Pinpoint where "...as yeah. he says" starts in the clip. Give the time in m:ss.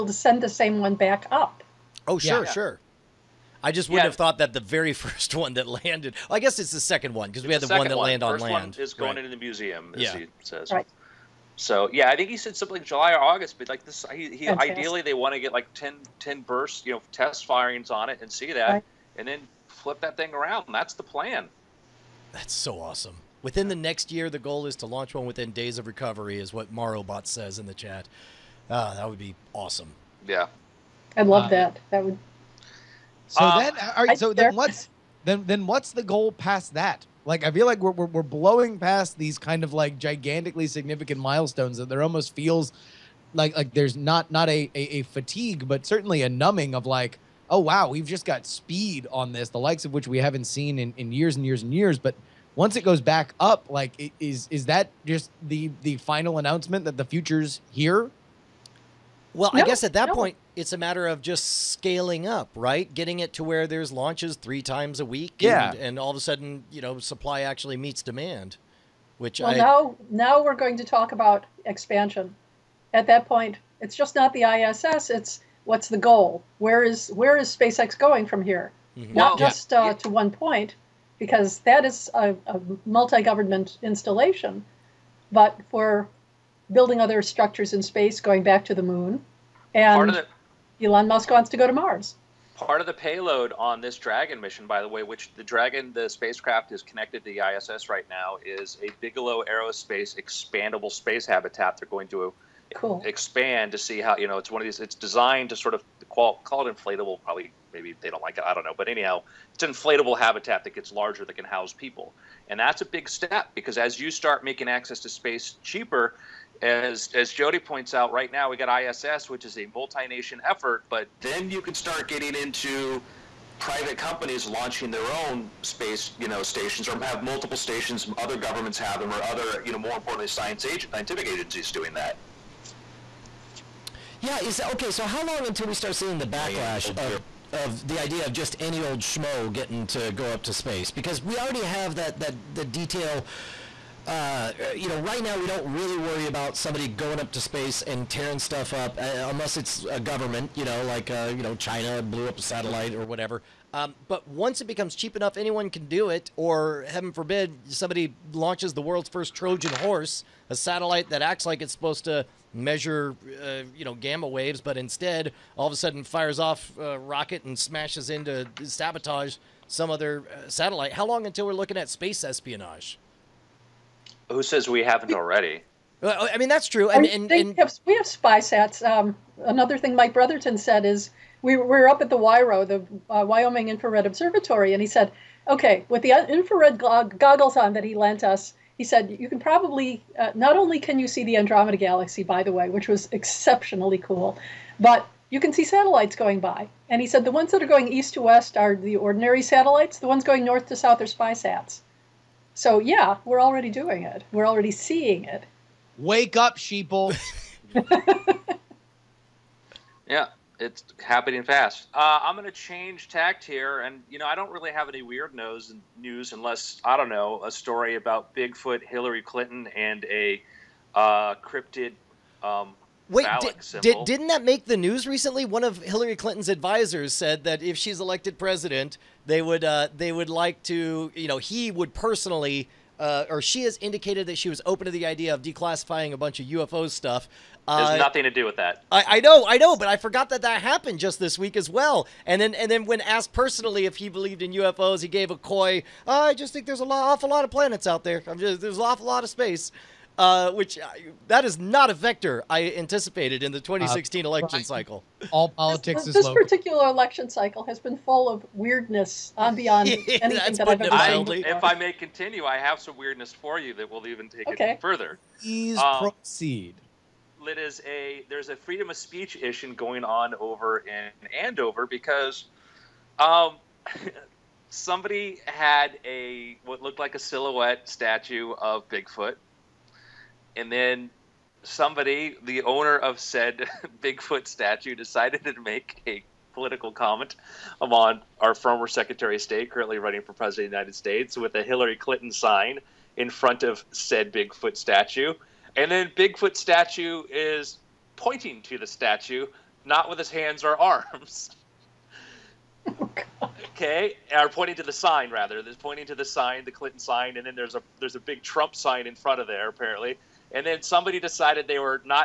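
0:09.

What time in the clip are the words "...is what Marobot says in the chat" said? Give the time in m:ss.
0:26.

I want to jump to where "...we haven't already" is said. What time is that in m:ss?
2:54.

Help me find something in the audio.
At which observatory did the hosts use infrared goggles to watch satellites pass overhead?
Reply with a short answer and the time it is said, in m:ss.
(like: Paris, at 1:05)
Wyoming Infrared Observatory, at 3:03.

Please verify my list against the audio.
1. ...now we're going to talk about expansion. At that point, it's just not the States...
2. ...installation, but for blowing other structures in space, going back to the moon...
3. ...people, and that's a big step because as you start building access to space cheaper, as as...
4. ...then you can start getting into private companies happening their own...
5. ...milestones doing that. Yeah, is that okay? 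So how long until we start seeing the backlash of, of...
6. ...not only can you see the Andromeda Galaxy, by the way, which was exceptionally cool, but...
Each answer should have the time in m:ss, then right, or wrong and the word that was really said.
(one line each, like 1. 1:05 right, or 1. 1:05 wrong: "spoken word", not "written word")
1. 1:10 wrong: "ISS", not "States"
2. 1:23 wrong: "building", not "blowing"
3. 1:51 wrong: "making", not "building"
4. 2:01 wrong: "launching", not "happening"
5. 2:11 wrong: "agencies", not "milestones"
6. 3:10 right.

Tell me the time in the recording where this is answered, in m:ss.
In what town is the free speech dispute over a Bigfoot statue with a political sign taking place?
4:31.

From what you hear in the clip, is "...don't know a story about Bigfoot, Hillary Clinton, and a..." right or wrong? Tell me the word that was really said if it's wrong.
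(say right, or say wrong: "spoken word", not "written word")
right.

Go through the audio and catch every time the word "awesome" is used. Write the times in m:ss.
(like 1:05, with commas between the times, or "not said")
0:22, 0:29.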